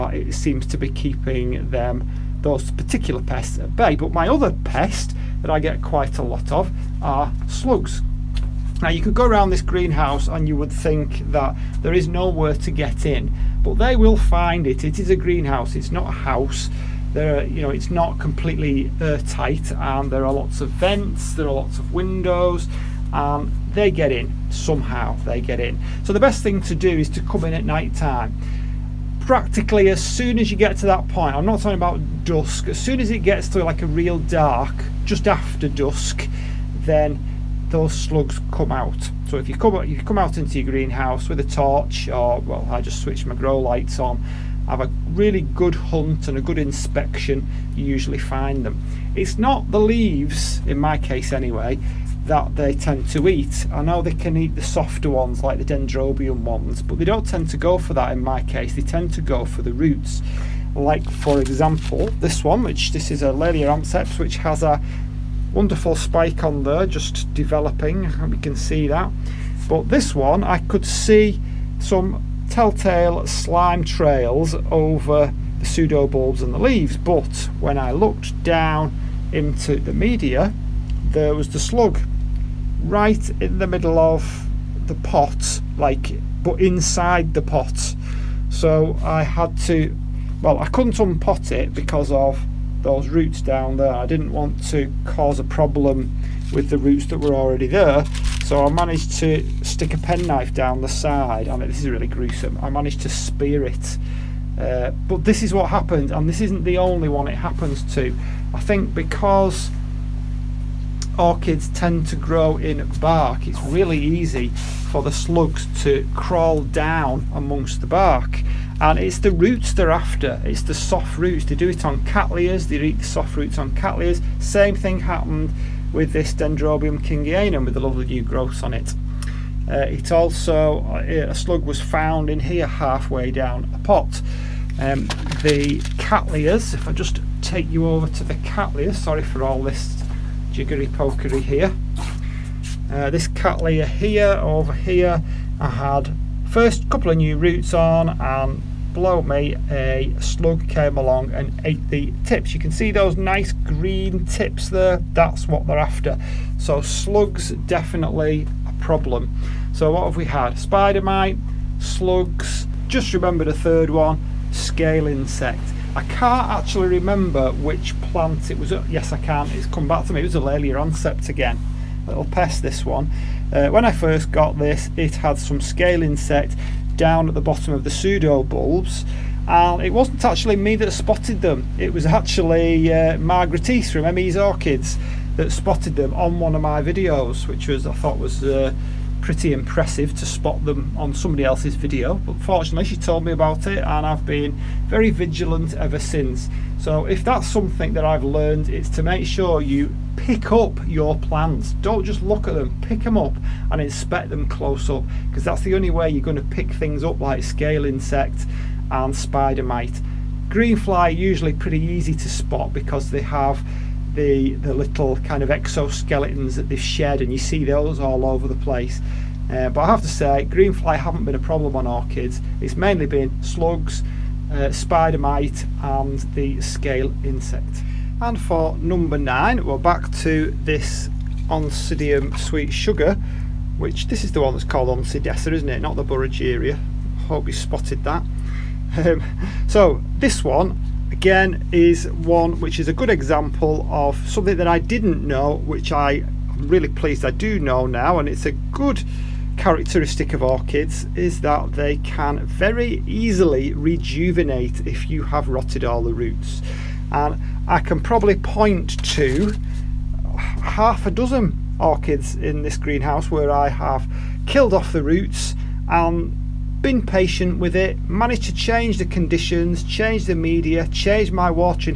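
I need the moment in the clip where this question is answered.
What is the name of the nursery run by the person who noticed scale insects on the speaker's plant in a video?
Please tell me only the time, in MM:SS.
03:04.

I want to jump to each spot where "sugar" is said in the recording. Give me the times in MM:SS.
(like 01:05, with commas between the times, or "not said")
03:52.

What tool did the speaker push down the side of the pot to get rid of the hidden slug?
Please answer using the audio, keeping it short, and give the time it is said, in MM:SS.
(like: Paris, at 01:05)
Penknife, at 01:39.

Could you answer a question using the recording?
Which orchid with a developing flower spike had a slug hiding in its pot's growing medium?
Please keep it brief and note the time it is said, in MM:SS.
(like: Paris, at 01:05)
Laelia anceps, at 01:03.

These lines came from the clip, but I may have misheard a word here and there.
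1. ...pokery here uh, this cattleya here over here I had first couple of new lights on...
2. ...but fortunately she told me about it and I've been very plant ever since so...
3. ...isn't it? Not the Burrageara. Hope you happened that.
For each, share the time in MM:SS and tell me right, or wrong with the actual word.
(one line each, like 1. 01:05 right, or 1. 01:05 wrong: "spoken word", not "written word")
1. 02:20 wrong: "roots", not "lights"
2. 03:12 wrong: "vigilant", not "plant"
3. 03:55 wrong: "spotted", not "happened".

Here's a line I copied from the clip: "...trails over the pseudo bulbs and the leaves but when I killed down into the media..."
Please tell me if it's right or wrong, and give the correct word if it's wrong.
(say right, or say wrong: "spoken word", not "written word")
wrong: "looked", not "killed".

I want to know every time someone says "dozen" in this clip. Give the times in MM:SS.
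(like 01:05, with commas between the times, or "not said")
04:21.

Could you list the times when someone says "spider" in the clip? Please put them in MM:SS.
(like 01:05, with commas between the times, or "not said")
02:40, 03:29, 03:44.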